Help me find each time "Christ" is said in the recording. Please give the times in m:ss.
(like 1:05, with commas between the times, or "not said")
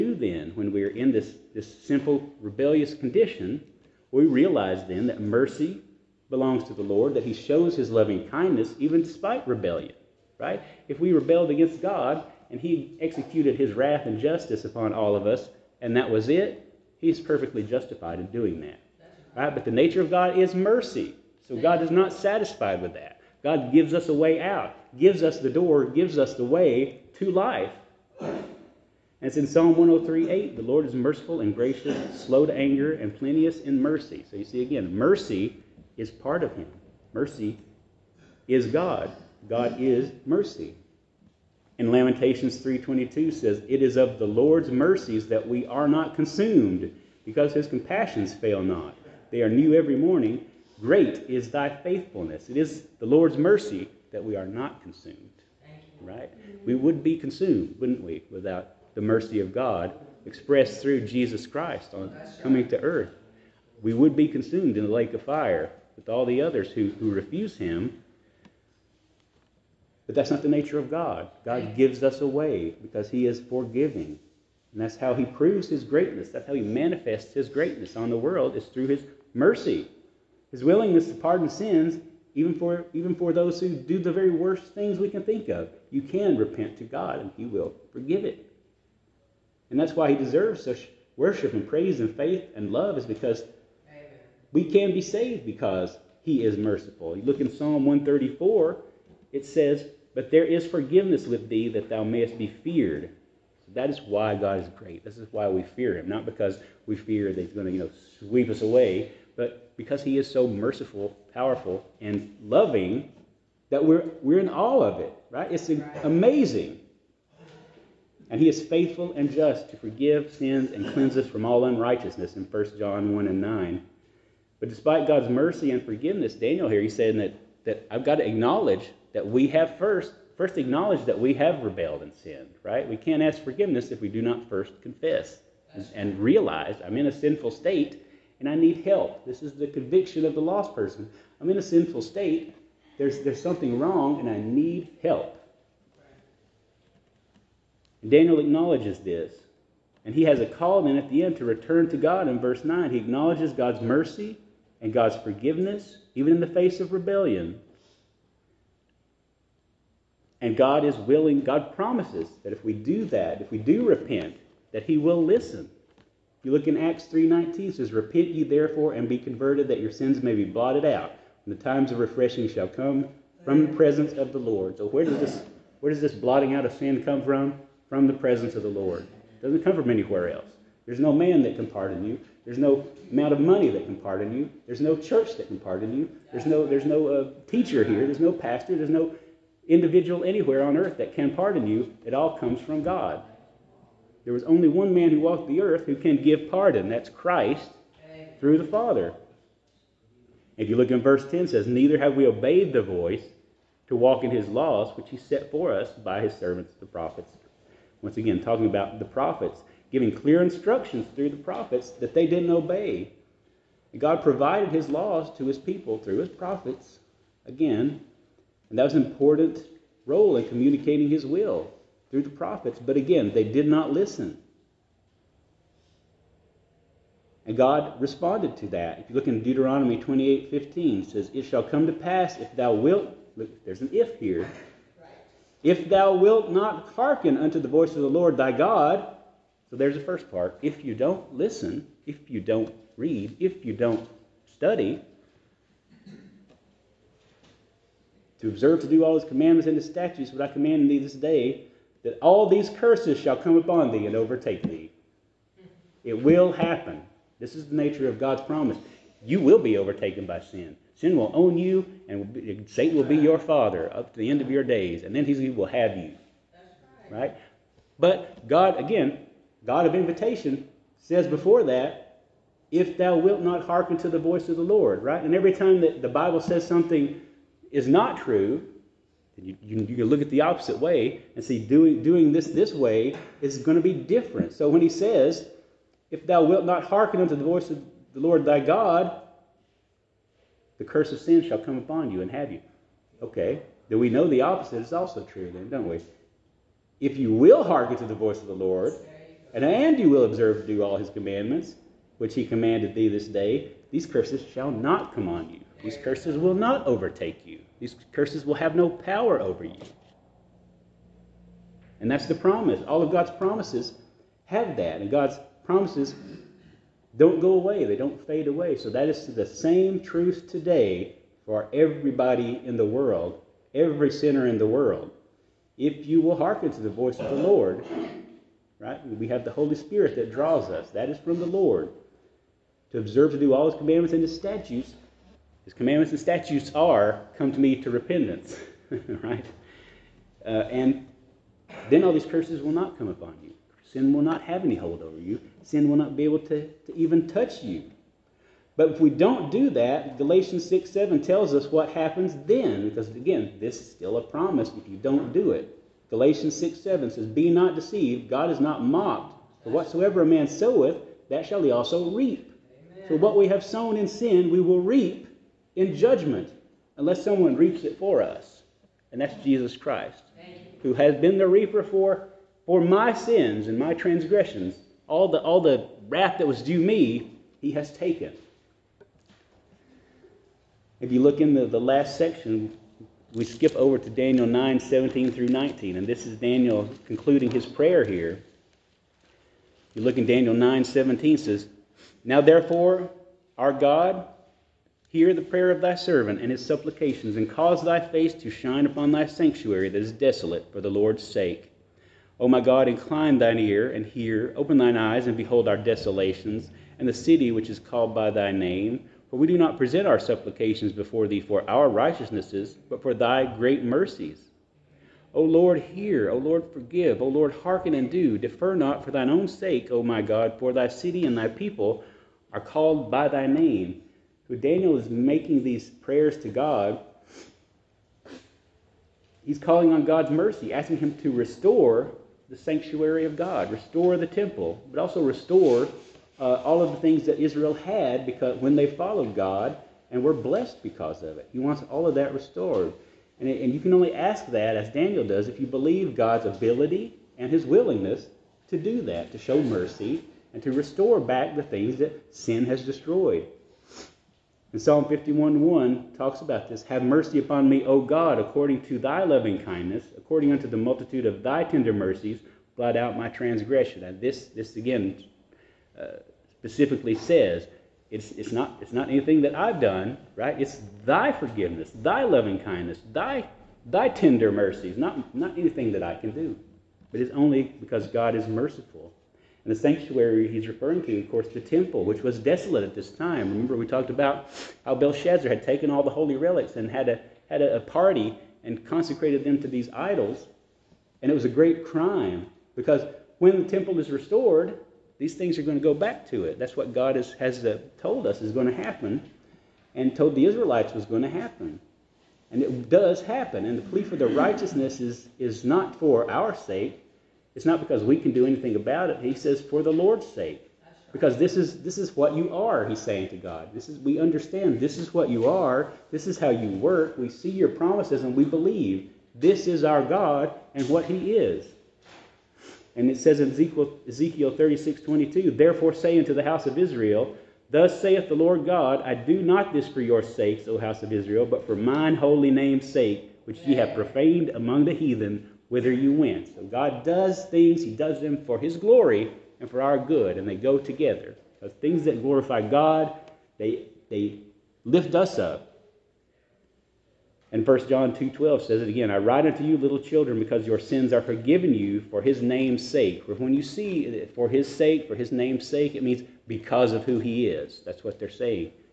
1:01, 3:17, 6:09.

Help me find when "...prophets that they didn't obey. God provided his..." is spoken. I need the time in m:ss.
3:31.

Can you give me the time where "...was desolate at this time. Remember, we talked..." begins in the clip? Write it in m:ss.
8:02.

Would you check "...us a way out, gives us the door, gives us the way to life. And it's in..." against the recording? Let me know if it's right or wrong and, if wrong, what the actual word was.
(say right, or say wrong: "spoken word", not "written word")
right.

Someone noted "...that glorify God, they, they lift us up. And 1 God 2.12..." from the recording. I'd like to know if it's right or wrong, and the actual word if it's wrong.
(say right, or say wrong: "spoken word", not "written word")
wrong: "John", not "God".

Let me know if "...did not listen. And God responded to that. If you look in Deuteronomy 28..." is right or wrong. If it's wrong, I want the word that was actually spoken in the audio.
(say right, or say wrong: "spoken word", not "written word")
right.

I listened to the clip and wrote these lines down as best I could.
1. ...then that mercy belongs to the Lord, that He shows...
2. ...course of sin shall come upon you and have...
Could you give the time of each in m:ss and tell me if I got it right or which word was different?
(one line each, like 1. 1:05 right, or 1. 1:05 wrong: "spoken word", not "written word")
1. 0:04 right
2. 4:50 wrong: "curse", not "course".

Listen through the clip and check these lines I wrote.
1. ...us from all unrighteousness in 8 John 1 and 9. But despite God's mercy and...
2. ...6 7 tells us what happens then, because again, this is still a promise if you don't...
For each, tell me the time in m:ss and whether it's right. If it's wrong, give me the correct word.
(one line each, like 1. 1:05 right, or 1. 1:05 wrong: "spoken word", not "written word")
1. 2:01 wrong: "1", not "8"
2. 5:50 right.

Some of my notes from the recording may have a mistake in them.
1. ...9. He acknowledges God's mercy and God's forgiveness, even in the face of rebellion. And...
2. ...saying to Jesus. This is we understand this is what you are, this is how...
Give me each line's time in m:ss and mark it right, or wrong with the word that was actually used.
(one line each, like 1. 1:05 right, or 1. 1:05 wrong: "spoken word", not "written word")
1. 2:32 right
2. 8:33 wrong: "God", not "Jesus".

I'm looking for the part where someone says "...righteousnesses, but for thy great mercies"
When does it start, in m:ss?
6:51.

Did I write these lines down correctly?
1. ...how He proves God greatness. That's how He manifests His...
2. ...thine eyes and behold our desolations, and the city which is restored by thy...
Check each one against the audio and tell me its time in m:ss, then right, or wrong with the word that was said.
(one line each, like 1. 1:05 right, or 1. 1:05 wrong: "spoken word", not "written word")
1. 1:14 wrong: "His", not "God"
2. 6:44 wrong: "called", not "restored".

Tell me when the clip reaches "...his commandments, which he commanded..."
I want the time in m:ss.
5:00.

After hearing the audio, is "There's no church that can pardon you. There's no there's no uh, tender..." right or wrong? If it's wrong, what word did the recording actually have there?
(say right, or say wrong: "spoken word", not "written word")
wrong: "teacher", not "tender".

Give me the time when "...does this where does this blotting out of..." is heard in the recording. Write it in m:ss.
2:55.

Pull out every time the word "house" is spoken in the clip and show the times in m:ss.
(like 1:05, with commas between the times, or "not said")
8:46, 8:50.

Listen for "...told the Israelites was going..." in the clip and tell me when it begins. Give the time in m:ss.
8:20.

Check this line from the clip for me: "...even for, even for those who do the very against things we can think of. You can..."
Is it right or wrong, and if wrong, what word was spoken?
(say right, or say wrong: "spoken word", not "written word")
wrong: "worst", not "against".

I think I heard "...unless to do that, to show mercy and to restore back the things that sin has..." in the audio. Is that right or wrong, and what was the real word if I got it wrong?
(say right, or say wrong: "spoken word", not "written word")
wrong: "willingness", not "unless".